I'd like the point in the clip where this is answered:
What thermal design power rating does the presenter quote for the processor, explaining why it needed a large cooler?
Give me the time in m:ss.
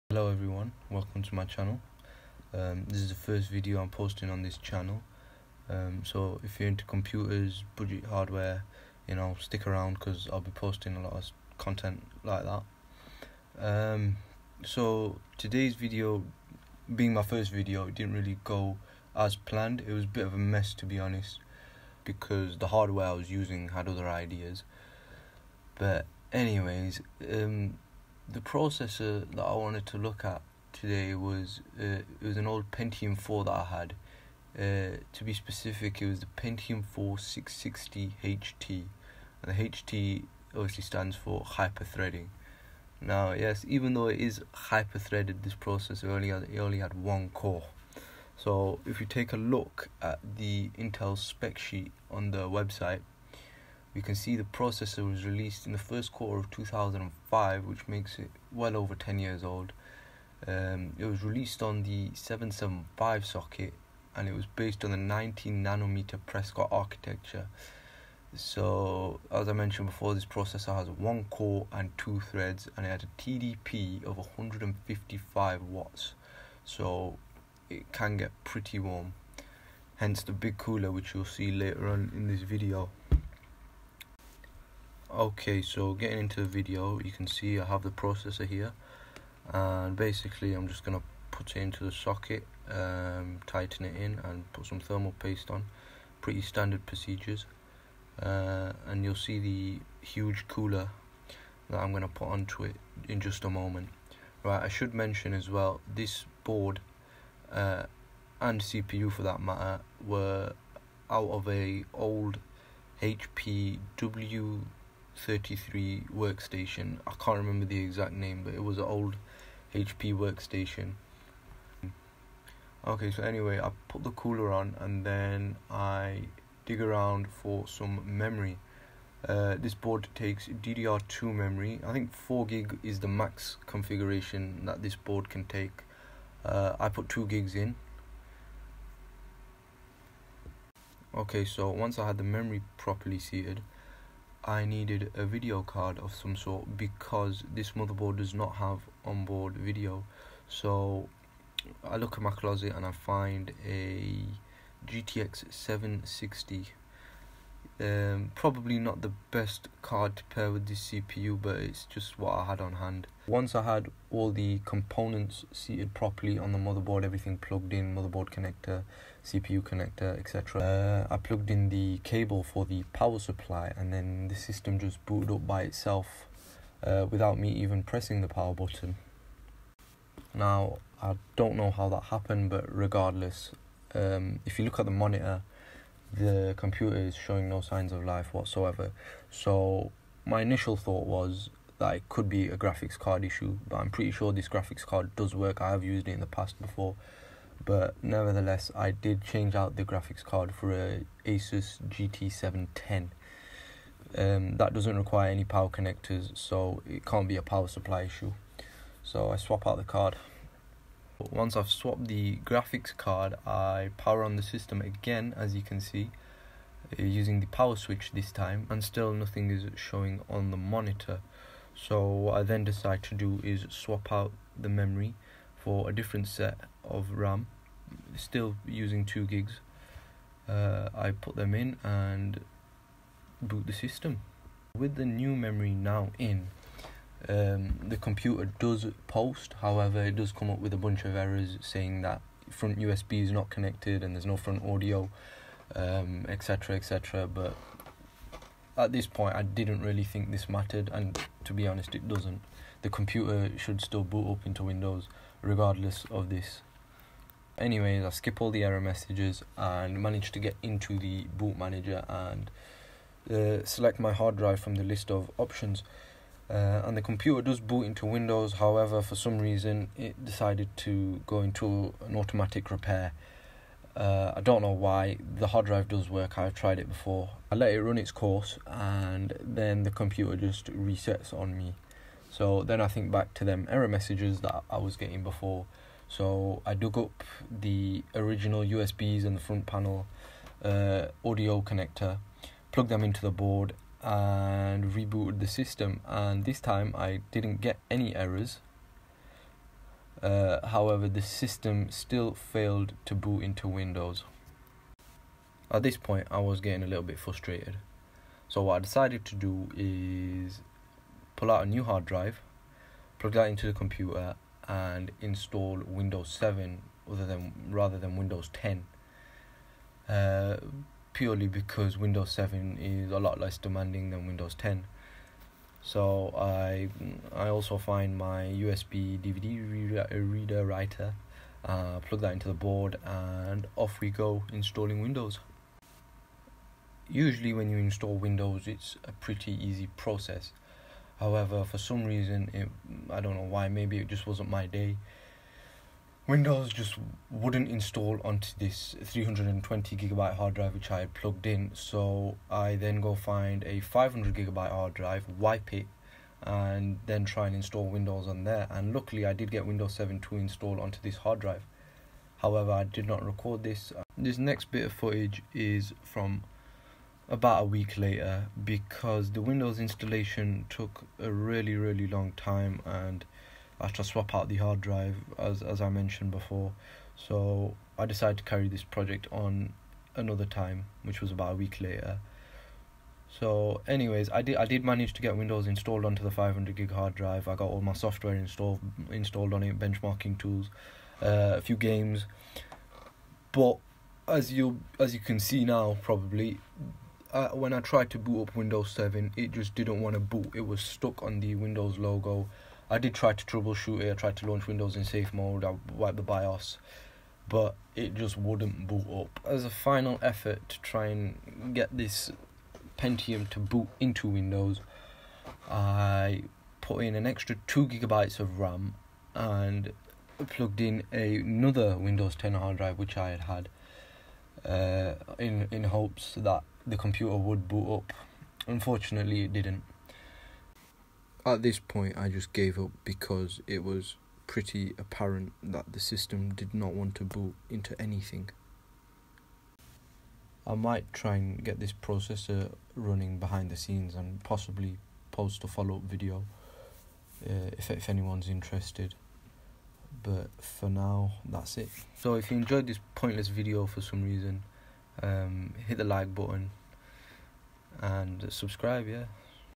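1:14.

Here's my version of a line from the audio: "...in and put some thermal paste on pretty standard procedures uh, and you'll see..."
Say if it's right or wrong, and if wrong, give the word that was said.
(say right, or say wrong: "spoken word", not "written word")
right.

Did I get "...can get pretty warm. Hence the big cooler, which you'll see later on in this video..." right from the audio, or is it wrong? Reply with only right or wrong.
right.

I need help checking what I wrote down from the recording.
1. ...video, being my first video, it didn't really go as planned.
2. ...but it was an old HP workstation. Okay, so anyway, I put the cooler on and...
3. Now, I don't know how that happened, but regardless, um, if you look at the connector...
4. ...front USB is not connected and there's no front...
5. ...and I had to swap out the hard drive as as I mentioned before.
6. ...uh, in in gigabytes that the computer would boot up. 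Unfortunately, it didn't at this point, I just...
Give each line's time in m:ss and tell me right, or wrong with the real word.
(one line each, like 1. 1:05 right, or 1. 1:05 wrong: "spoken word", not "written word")
1. 0:15 right
2. 1:58 right
3. 3:00 wrong: "monitor", not "connector"
4. 4:02 right
5. 6:12 right
6. 7:04 wrong: "hopes", not "gigabytes".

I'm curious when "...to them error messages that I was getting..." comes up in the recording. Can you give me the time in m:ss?
4:43.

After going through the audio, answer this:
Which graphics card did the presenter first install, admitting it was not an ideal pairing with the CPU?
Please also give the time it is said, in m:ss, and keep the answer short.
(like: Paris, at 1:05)
GTX 760, at 2:34.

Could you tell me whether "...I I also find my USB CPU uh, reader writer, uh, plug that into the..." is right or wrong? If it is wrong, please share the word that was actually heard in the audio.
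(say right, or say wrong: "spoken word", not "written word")
wrong: "DVD", not "CPU".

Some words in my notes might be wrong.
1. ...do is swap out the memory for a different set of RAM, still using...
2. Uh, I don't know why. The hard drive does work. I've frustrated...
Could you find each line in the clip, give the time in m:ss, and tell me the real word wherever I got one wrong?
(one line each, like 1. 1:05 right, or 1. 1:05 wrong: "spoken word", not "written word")
1. 3:43 right
2. 4:33 wrong: "tried", not "frustrated".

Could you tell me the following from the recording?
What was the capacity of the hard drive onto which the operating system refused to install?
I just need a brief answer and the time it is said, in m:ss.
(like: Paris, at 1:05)
320 gigabyte, at 5:49.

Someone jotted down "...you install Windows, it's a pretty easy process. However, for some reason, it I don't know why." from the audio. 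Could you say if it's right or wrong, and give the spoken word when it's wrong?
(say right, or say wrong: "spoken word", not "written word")
right.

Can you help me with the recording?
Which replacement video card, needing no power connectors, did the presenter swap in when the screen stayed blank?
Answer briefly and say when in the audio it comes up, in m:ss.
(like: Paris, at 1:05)
Asus GT710, at 3:21.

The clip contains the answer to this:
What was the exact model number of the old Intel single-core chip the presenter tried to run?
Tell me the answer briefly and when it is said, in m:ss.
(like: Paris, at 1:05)
Pentium 4 660 HT, at 0:36.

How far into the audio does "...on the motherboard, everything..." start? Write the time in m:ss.
2:46.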